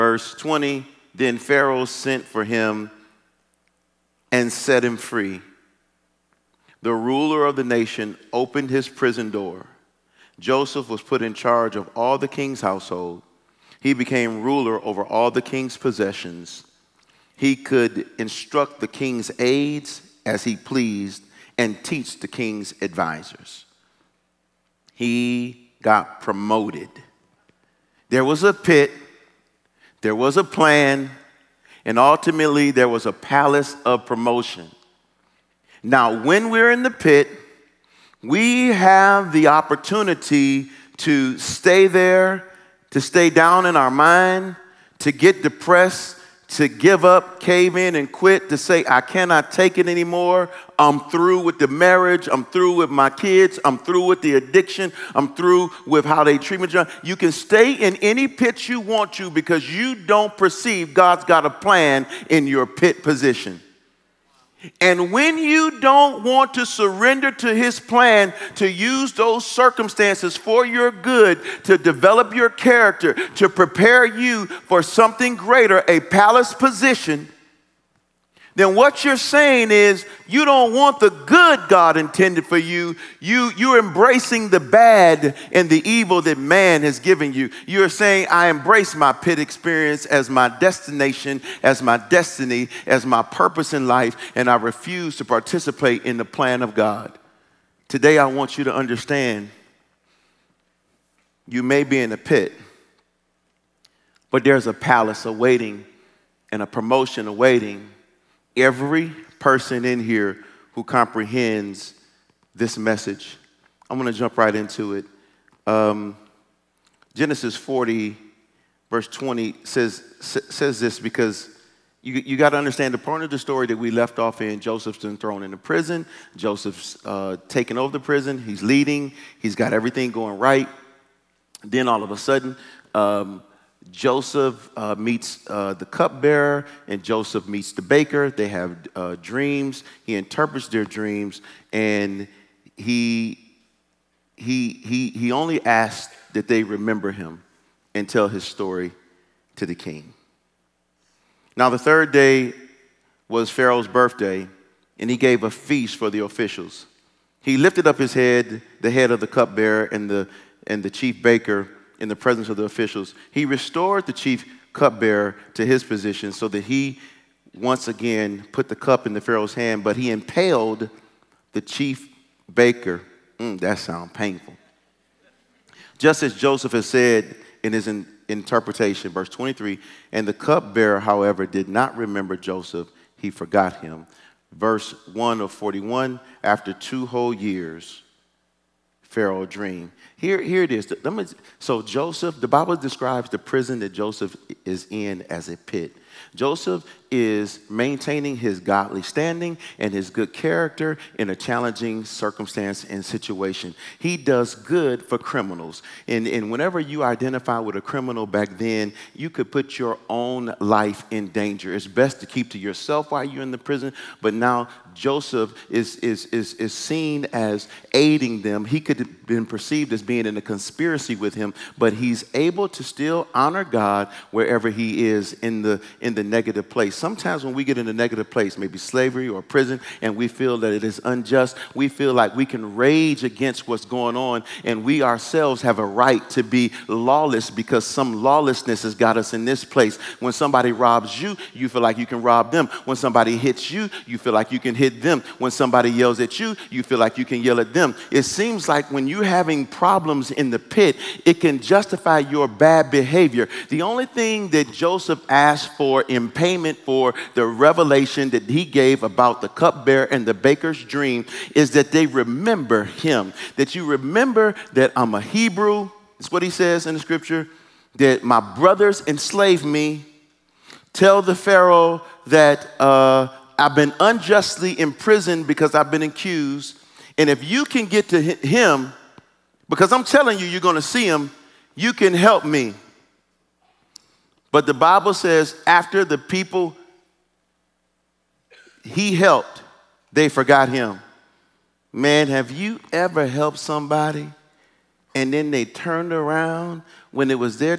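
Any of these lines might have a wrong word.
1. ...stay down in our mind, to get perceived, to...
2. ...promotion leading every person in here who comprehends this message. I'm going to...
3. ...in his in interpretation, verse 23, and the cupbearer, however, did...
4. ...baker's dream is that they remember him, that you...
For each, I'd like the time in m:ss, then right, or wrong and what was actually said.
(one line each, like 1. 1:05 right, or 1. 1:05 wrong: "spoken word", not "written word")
1. 0:43 wrong: "depressed", not "perceived"
2. 1:46 wrong: "awaiting", not "leading"
3. 2:57 right
4. 4:20 right.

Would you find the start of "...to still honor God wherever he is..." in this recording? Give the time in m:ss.
3:42.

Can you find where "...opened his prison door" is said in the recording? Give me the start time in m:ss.
0:08.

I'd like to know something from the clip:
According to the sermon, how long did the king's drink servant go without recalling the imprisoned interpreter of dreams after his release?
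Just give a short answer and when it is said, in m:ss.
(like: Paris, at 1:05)
2 years, at 3:06.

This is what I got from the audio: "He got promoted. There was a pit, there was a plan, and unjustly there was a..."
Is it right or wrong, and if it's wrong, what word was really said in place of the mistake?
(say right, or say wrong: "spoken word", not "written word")
wrong: "ultimately", not "unjustly".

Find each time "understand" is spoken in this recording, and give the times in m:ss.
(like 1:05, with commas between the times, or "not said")
1:38, 2:02.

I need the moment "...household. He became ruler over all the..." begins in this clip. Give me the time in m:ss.
0:12.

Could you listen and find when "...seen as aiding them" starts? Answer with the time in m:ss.
3:36.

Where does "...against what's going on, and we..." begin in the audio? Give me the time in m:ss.
3:53.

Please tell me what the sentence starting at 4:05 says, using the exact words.
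When somebody yells at you, you feel like you can yell at them.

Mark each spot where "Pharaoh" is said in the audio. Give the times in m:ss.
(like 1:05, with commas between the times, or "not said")
0:01, 2:33, 2:49, 3:09, 4:31.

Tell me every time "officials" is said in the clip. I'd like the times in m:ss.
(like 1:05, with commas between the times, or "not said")
2:36, 2:42.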